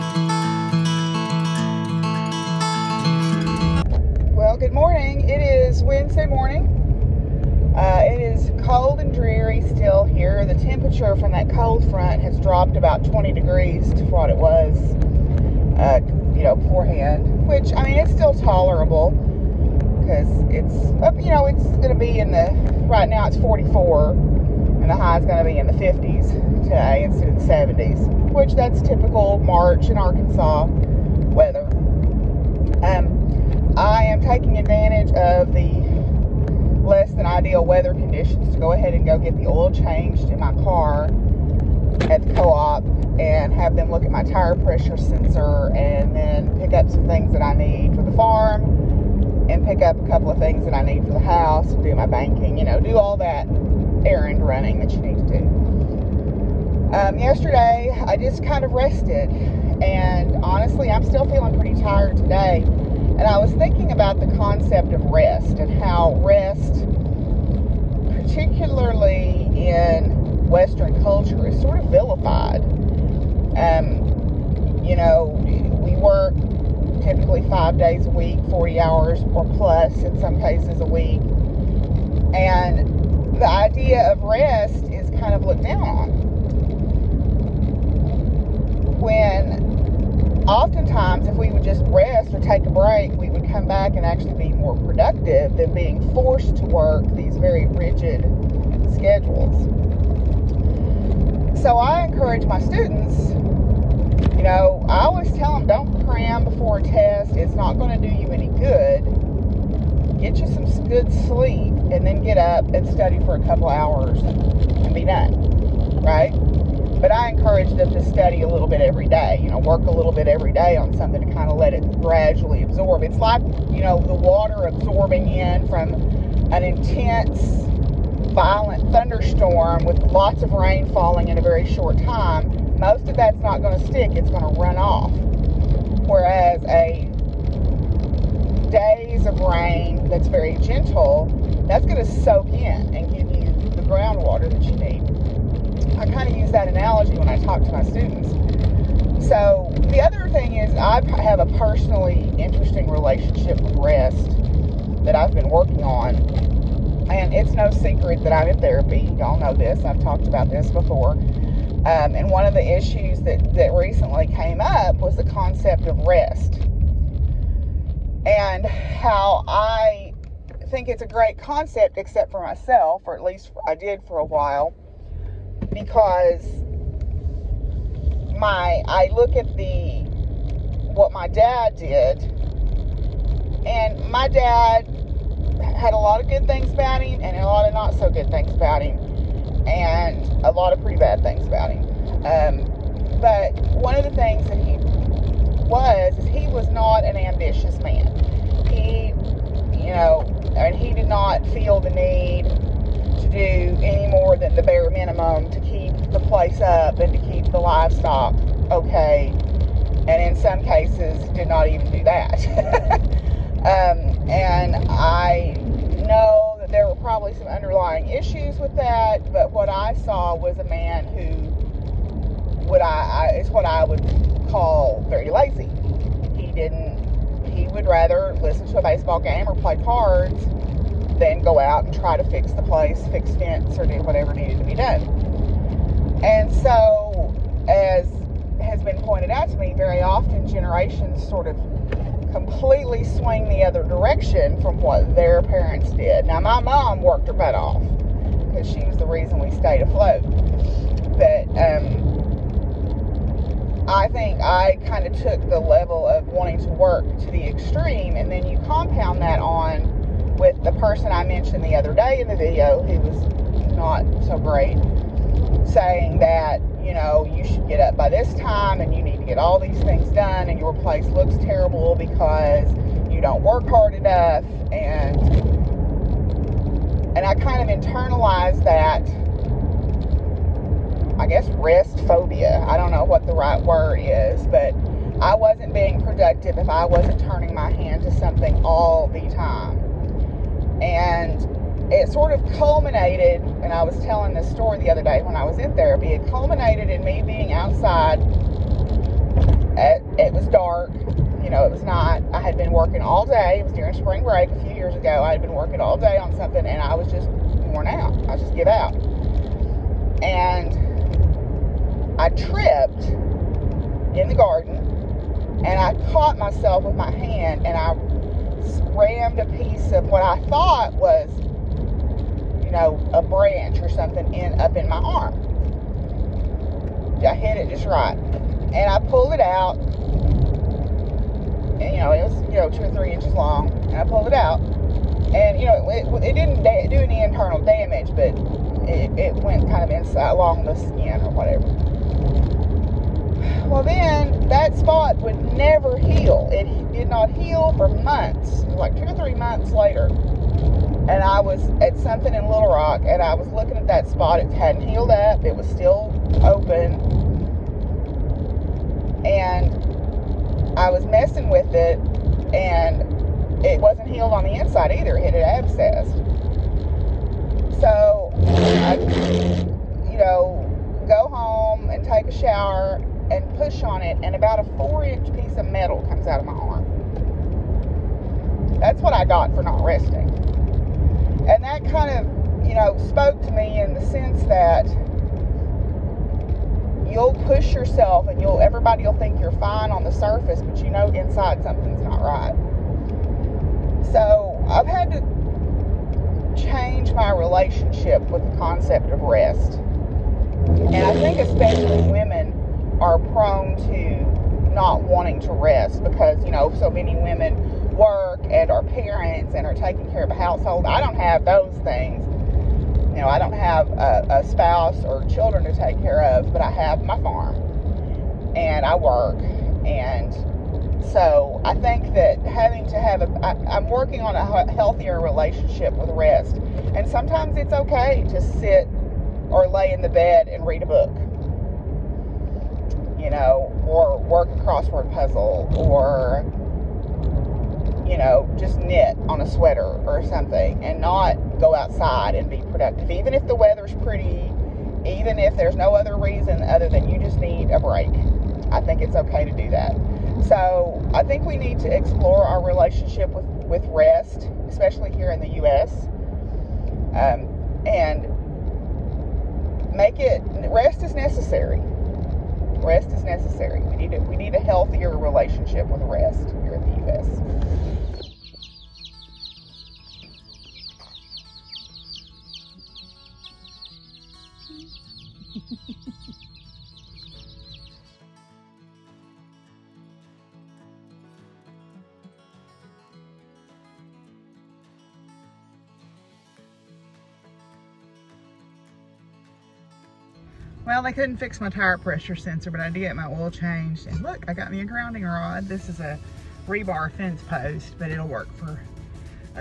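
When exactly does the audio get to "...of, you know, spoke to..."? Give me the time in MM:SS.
06:22.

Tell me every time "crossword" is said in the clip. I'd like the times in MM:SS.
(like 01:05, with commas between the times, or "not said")
07:14.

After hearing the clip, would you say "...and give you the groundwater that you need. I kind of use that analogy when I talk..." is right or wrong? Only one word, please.
right.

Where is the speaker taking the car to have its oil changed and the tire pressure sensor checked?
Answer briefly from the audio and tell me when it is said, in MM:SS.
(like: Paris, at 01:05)
the co-op, at 00:42.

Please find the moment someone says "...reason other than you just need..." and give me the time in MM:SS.
07:26.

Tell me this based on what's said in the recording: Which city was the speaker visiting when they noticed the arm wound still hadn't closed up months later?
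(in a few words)
Little Rock.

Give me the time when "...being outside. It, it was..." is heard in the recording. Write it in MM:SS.
04:57.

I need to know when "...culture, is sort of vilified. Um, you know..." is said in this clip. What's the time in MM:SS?
01:11.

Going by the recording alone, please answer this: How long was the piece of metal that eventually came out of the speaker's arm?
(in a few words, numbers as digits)
4 inches.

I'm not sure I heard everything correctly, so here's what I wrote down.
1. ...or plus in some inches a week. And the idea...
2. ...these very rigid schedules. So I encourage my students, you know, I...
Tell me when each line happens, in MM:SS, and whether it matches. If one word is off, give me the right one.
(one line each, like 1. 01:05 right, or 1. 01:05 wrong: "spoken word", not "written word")
1. 01:19 wrong: "cases", not "inches"
2. 01:37 right.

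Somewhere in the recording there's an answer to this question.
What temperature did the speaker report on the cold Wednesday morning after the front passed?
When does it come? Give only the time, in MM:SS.
00:23.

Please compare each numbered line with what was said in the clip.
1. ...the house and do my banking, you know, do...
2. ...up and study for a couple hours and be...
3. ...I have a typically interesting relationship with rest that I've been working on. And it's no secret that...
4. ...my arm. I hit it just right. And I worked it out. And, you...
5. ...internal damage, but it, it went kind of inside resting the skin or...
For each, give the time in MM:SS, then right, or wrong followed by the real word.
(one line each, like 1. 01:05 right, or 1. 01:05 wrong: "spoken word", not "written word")
1. 00:51 right
2. 01:52 right
3. 02:30 wrong: "personally", not "typically"
4. 05:24 wrong: "pulled", not "worked"
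5. 05:37 wrong: "along", not "resting".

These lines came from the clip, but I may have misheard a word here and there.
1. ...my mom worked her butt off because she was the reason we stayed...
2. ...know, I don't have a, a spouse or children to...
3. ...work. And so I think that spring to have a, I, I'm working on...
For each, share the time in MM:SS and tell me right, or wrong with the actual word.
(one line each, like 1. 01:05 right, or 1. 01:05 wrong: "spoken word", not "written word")
1. 04:06 right
2. 06:53 right
3. 06:58 wrong: "having", not "spring".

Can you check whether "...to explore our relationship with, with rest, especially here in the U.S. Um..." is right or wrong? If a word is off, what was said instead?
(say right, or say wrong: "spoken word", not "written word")
right.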